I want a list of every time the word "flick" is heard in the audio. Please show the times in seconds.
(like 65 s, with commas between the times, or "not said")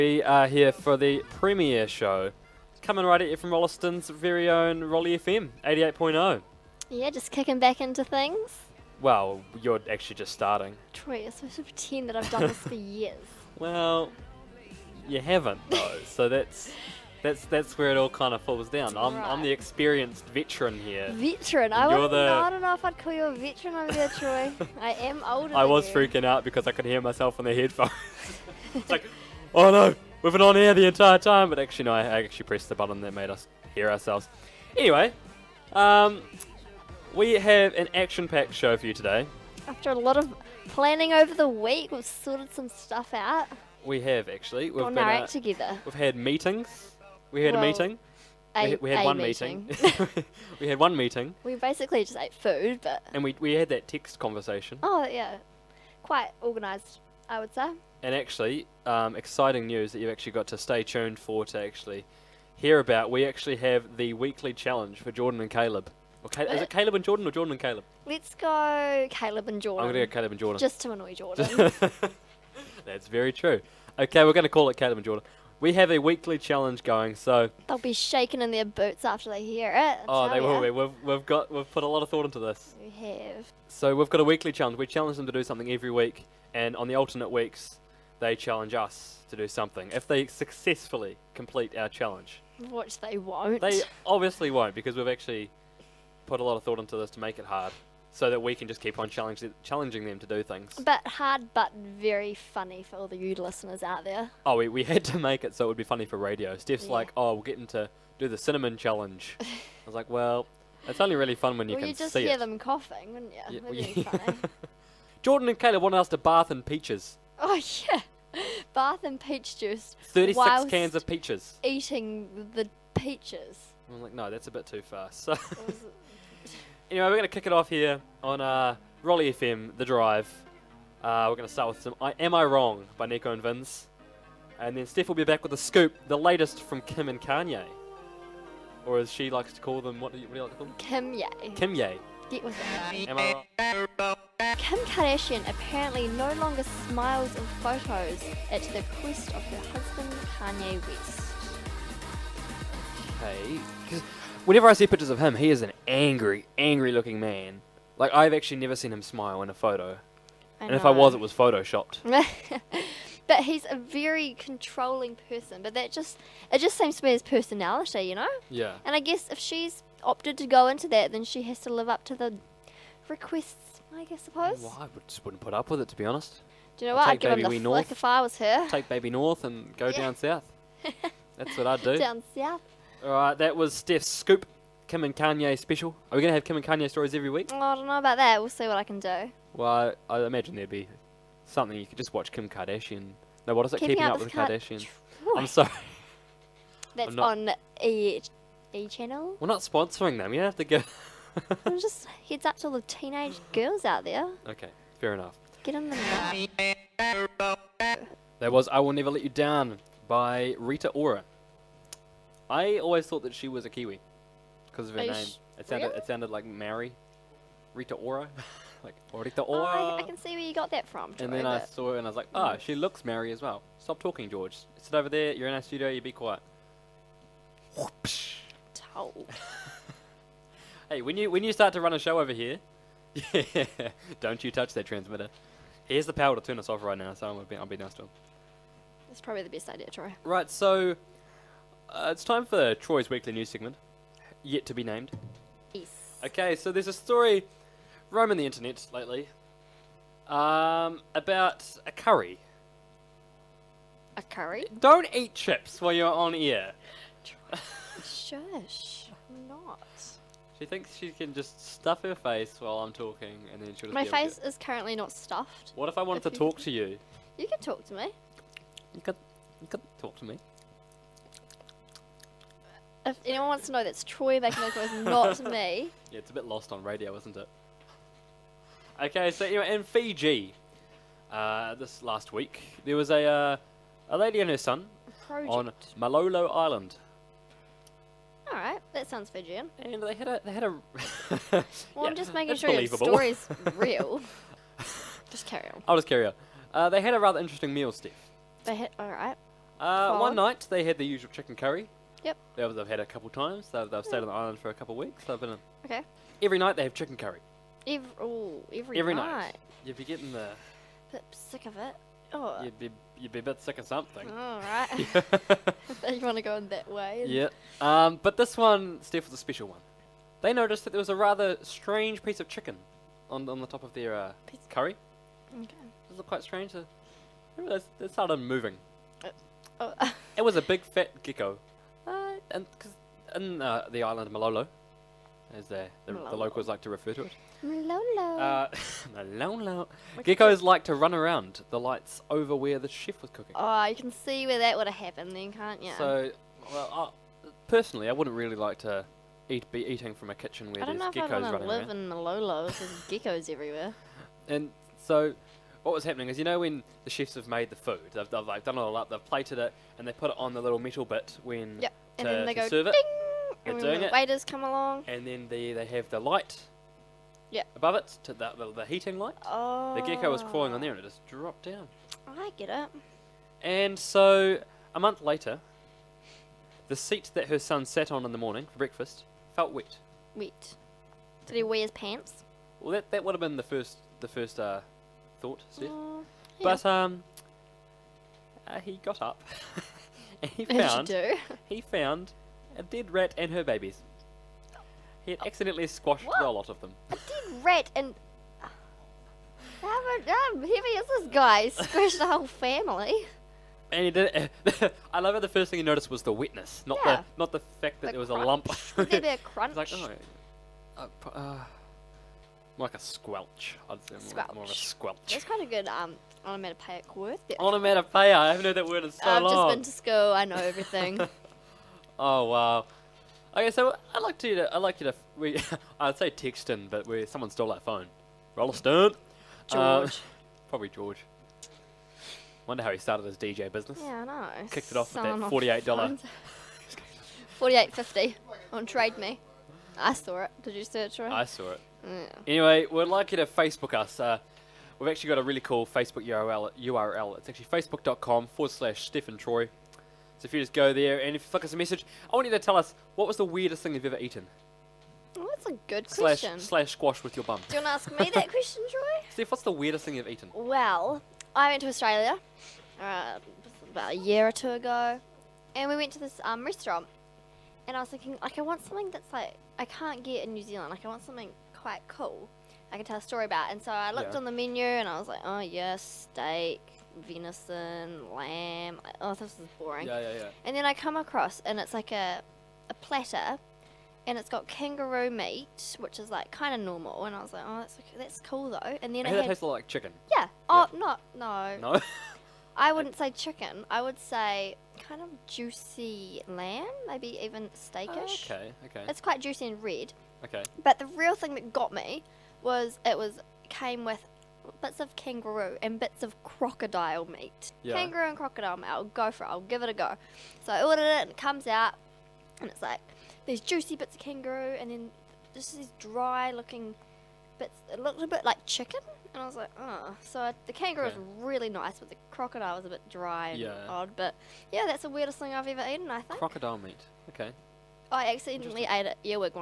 177 s, 451 s.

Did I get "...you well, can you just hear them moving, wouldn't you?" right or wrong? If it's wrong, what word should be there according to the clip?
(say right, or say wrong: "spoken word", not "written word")
wrong: "coughing", not "moving".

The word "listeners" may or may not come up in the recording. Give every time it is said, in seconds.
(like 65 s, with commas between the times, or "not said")
103 s.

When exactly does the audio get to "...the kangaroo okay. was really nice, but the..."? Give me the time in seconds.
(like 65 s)
520 s.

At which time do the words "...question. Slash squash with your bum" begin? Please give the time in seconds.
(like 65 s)
456 s.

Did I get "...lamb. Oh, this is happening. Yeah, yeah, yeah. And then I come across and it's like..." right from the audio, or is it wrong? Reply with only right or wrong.
wrong.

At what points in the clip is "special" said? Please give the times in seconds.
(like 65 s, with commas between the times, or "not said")
185 s, 319 s.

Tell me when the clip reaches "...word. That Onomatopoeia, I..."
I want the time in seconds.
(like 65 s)
417 s.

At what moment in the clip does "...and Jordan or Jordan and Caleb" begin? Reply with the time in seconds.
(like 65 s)
66 s.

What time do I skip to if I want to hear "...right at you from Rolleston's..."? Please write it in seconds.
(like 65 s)
3 s.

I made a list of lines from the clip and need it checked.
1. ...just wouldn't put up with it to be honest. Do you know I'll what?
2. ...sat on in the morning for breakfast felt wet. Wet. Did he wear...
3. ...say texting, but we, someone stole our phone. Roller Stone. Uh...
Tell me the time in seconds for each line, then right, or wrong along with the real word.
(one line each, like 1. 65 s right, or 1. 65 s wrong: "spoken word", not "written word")
1. 175 s right
2. 377 s right
3. 426 s right.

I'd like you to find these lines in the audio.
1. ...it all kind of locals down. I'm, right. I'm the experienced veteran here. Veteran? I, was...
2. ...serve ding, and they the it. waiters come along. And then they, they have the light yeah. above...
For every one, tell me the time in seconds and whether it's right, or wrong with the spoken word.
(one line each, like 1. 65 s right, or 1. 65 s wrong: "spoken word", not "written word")
1. 17 s wrong: "falls", not "locals"
2. 362 s right.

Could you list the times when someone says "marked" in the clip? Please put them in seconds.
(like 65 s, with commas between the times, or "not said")
not said.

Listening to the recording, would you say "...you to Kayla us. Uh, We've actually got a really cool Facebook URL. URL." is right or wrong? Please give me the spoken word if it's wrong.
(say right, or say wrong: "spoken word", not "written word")
wrong: "Facebook", not "Kayla".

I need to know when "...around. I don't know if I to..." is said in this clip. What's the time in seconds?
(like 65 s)
351 s.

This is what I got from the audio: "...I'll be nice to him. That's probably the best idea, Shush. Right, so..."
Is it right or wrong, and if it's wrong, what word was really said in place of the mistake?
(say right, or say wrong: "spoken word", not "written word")
wrong: "Troy", not "Shush".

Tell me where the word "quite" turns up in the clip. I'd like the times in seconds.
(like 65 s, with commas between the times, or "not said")
56 s, 326 s, 471 s, 499 s.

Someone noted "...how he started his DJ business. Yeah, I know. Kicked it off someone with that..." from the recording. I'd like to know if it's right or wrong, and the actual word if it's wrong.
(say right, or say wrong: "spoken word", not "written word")
right.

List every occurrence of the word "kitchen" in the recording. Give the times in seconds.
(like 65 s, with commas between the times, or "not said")
350 s.